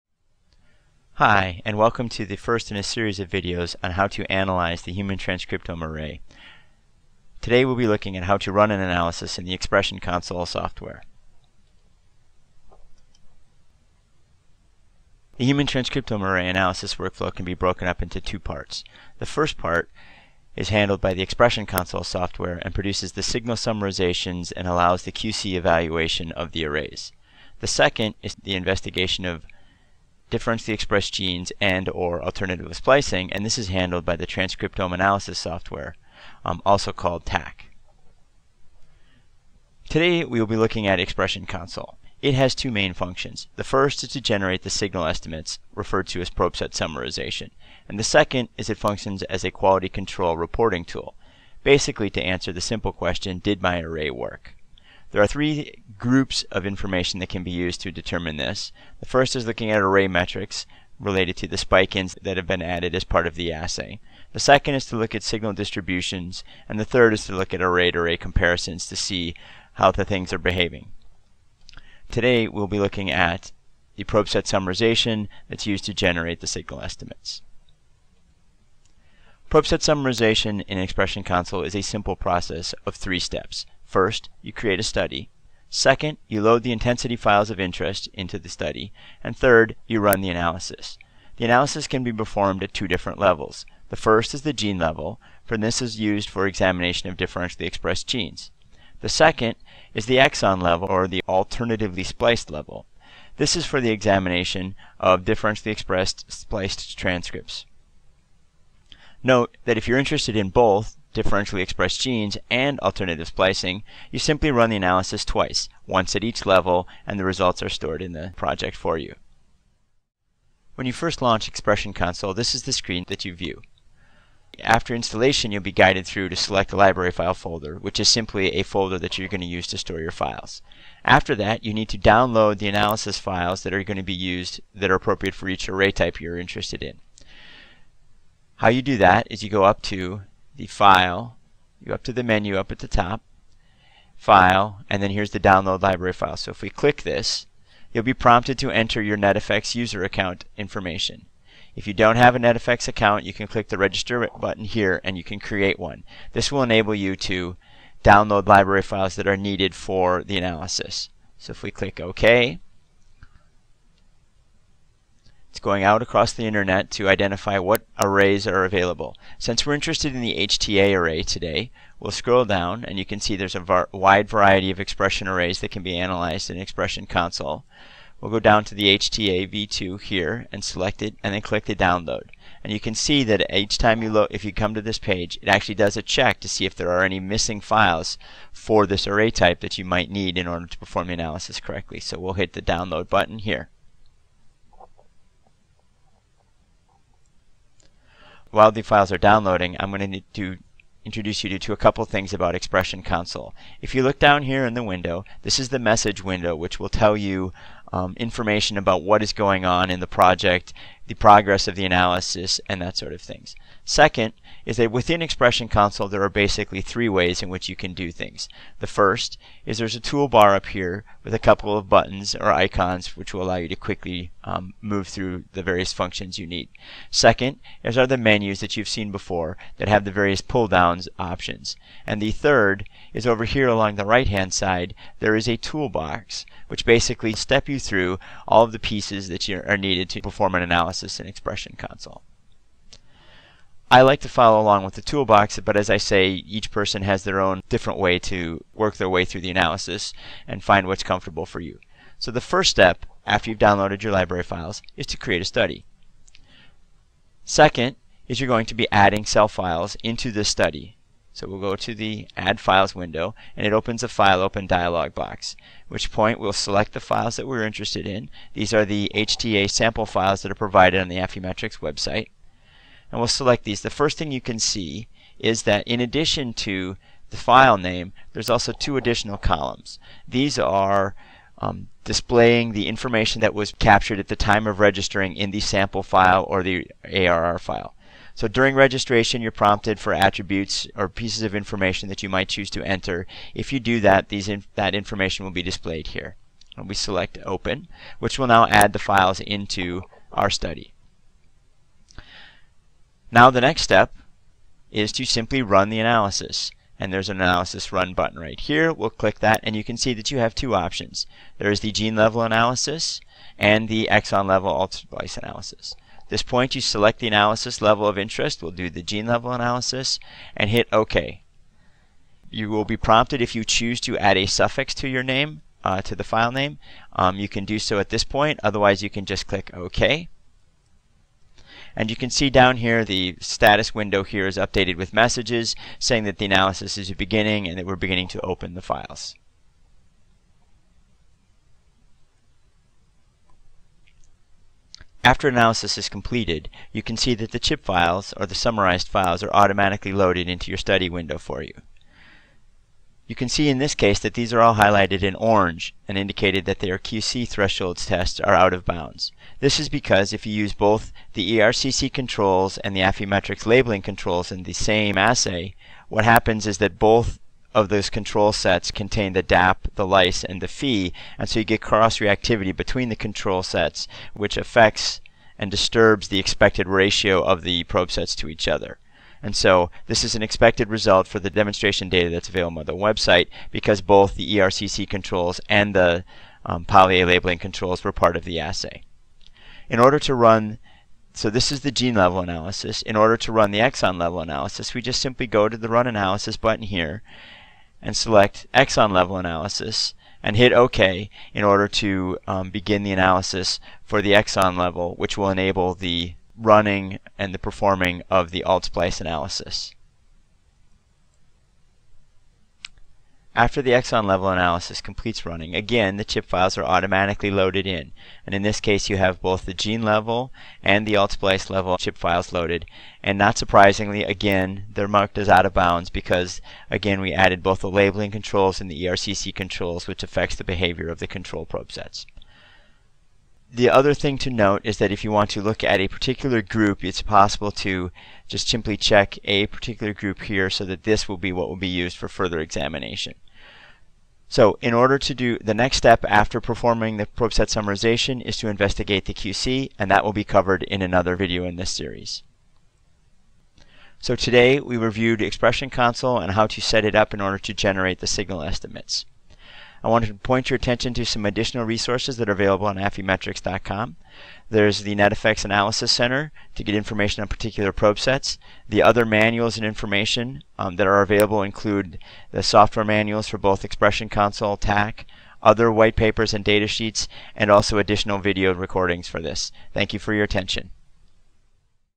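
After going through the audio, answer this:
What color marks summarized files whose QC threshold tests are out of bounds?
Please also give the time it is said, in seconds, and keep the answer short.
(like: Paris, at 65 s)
orange, at 355 s.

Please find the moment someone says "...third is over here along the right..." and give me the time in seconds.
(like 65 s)
232 s.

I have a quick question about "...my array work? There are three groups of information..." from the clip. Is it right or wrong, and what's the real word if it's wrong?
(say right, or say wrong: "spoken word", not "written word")
right.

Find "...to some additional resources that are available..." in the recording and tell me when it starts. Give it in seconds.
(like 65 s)
461 s.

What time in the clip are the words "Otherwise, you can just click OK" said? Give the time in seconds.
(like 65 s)
328 s.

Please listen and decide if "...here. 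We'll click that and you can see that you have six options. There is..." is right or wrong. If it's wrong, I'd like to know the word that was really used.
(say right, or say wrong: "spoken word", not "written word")
wrong: "two", not "six".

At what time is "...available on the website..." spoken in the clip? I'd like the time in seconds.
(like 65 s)
382 s.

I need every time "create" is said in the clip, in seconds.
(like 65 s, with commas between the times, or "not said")
84 s, 155 s, 255 s.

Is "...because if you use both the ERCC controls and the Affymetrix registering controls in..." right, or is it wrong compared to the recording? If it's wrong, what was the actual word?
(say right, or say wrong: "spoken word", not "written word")
wrong: "labeling", not "registering".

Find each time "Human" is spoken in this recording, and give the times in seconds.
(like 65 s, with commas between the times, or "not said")
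4 s, 15 s.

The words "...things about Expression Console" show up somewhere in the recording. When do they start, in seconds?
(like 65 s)
202 s.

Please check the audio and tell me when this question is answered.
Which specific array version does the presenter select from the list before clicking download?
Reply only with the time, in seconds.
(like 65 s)
178 s.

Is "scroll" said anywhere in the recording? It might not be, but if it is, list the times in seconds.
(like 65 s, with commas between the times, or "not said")
172 s.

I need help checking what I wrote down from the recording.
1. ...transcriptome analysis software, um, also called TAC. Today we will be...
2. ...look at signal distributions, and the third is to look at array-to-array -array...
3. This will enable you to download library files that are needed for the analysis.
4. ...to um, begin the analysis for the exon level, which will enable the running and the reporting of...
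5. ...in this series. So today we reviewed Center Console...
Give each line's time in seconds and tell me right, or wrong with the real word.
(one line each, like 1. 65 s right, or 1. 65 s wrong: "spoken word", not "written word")
1. 34 s right
2. 64 s right
3. 156 s right
4. 401 s wrong: "performing", not "reporting"
5. 451 s wrong: "Expression", not "Center".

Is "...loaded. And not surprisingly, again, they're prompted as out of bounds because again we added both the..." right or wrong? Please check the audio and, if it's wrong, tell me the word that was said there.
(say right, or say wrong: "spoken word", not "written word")
wrong: "marked", not "prompted".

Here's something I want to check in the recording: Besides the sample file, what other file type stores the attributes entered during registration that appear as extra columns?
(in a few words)
ARR file.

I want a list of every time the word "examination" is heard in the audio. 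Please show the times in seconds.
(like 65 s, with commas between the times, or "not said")
96 s, 103 s, 442 s.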